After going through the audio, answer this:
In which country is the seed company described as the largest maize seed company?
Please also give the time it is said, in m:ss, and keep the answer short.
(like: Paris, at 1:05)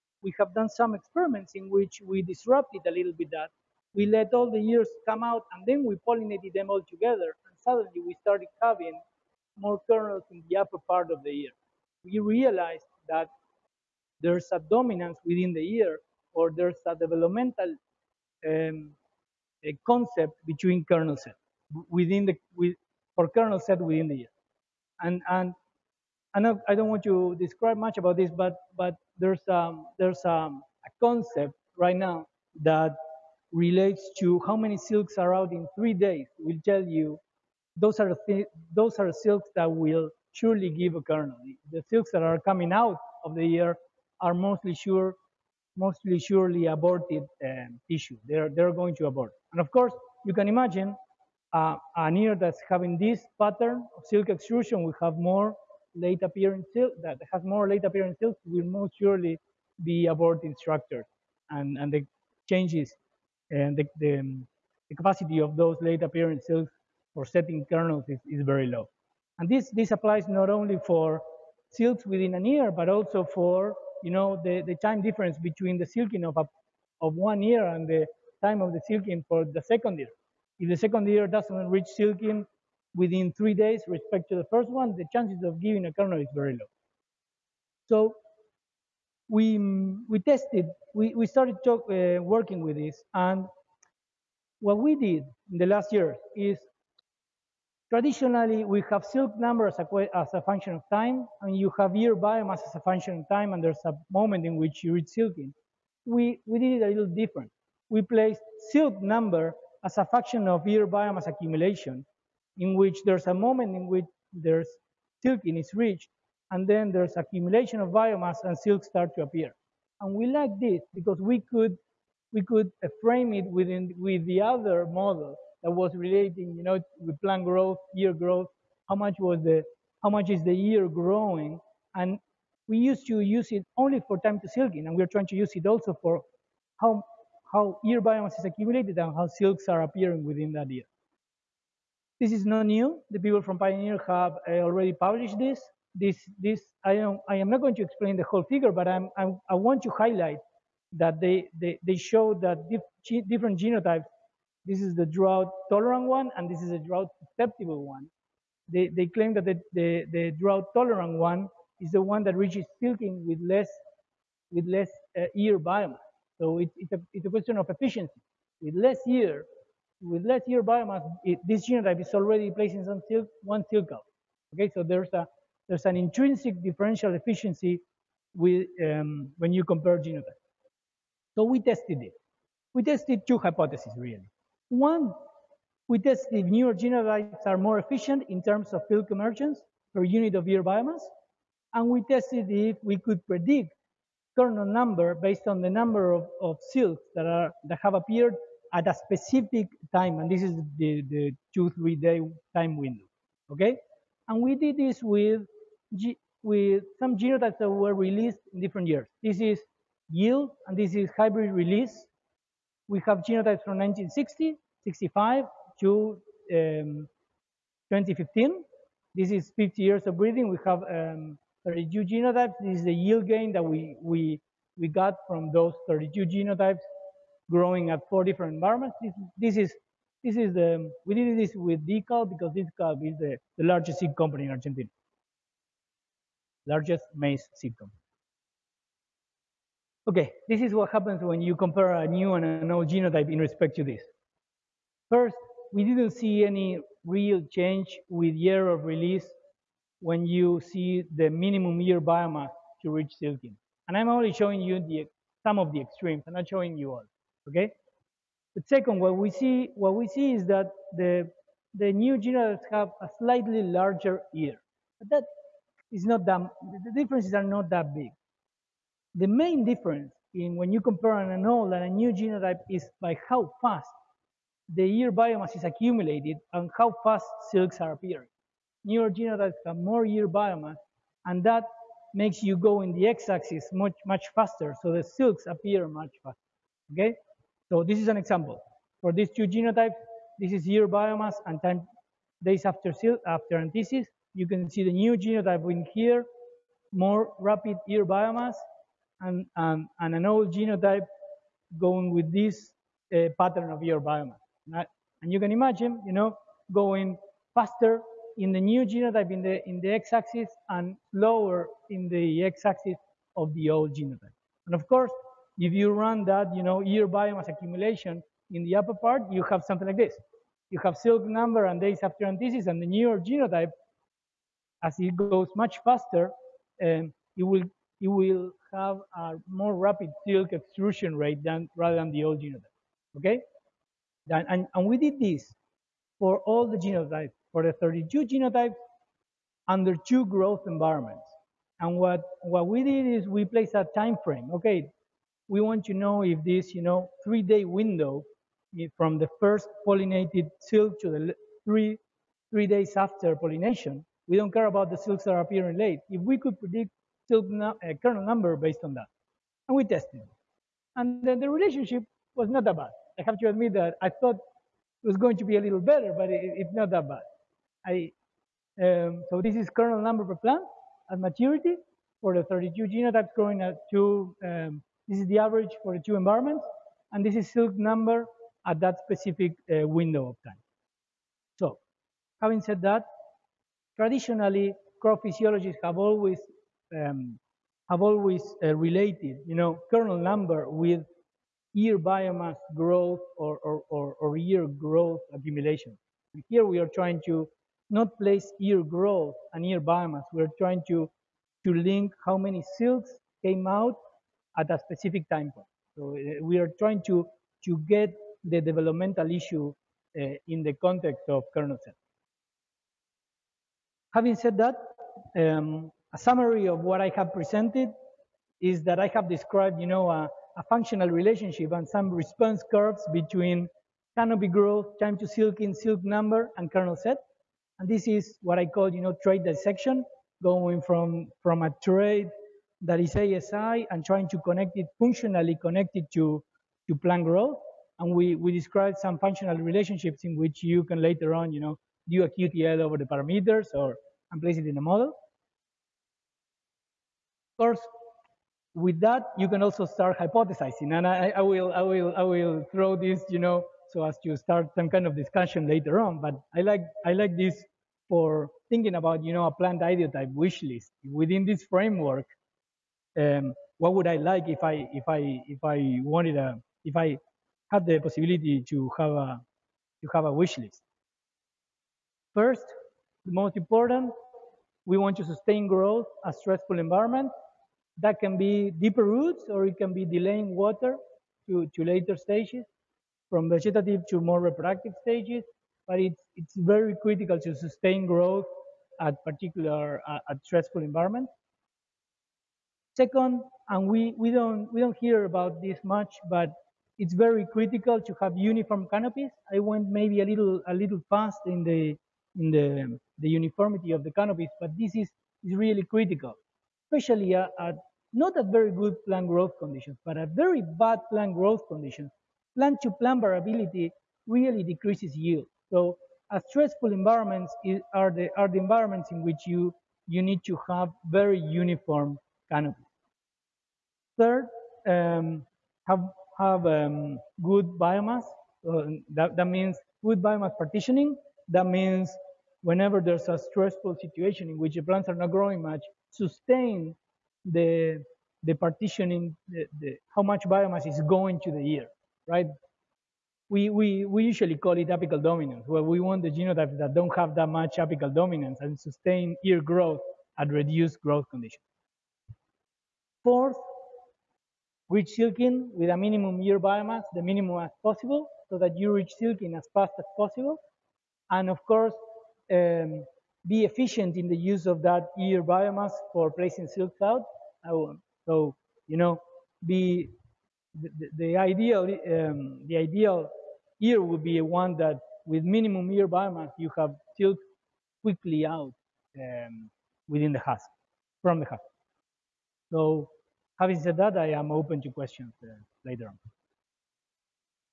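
Argentina, at 3:54.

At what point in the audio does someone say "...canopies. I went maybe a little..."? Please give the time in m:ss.
8:18.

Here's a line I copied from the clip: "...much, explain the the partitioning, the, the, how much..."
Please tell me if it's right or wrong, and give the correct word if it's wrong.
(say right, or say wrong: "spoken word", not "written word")
wrong: "sustain", not "explain".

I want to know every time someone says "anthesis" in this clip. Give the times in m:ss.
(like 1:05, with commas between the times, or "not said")
4:53, 5:22.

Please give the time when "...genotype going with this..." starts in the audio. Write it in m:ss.
5:00.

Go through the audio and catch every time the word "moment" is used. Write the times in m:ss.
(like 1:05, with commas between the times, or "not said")
1:44, 1:53.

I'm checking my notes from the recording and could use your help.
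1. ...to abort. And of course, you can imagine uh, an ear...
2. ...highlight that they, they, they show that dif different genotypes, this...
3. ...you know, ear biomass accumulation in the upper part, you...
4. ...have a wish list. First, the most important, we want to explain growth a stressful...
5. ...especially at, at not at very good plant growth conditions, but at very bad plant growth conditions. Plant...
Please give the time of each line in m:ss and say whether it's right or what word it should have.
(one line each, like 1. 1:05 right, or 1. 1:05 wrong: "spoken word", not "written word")
1. 0:48 right
2. 2:29 right
3. 5:16 right
4. 7:50 wrong: "sustain", not "explain"
5. 8:26 right.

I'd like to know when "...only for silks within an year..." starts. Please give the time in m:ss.
1:10.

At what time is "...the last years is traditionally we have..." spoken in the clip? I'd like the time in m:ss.
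1:35.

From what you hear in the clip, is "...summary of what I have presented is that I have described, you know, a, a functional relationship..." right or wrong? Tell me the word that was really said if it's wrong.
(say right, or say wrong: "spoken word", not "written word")
right.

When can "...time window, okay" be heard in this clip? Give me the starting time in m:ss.
3:22.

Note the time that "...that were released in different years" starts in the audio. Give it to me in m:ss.
3:27.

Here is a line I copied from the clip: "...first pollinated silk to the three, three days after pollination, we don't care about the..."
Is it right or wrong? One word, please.
right.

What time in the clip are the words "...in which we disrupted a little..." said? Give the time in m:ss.
0:01.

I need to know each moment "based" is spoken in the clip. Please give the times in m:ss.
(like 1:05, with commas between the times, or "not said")
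3:15, 5:58.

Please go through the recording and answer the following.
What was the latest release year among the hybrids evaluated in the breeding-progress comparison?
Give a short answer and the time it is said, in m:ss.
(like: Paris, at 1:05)
2015, at 3:37.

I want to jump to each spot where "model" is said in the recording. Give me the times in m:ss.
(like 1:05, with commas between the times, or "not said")
2:04, 7:24.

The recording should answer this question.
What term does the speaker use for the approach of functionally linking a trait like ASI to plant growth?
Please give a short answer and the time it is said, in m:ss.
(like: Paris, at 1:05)
trait dissection, at 7:09.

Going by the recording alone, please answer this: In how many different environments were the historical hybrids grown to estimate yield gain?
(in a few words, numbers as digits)
4.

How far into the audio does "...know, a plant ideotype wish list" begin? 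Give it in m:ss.
7:39.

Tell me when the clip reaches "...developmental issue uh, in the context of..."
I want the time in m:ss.
6:48.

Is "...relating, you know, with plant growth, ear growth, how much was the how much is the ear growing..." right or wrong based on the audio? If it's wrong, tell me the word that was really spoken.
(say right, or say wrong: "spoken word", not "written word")
right.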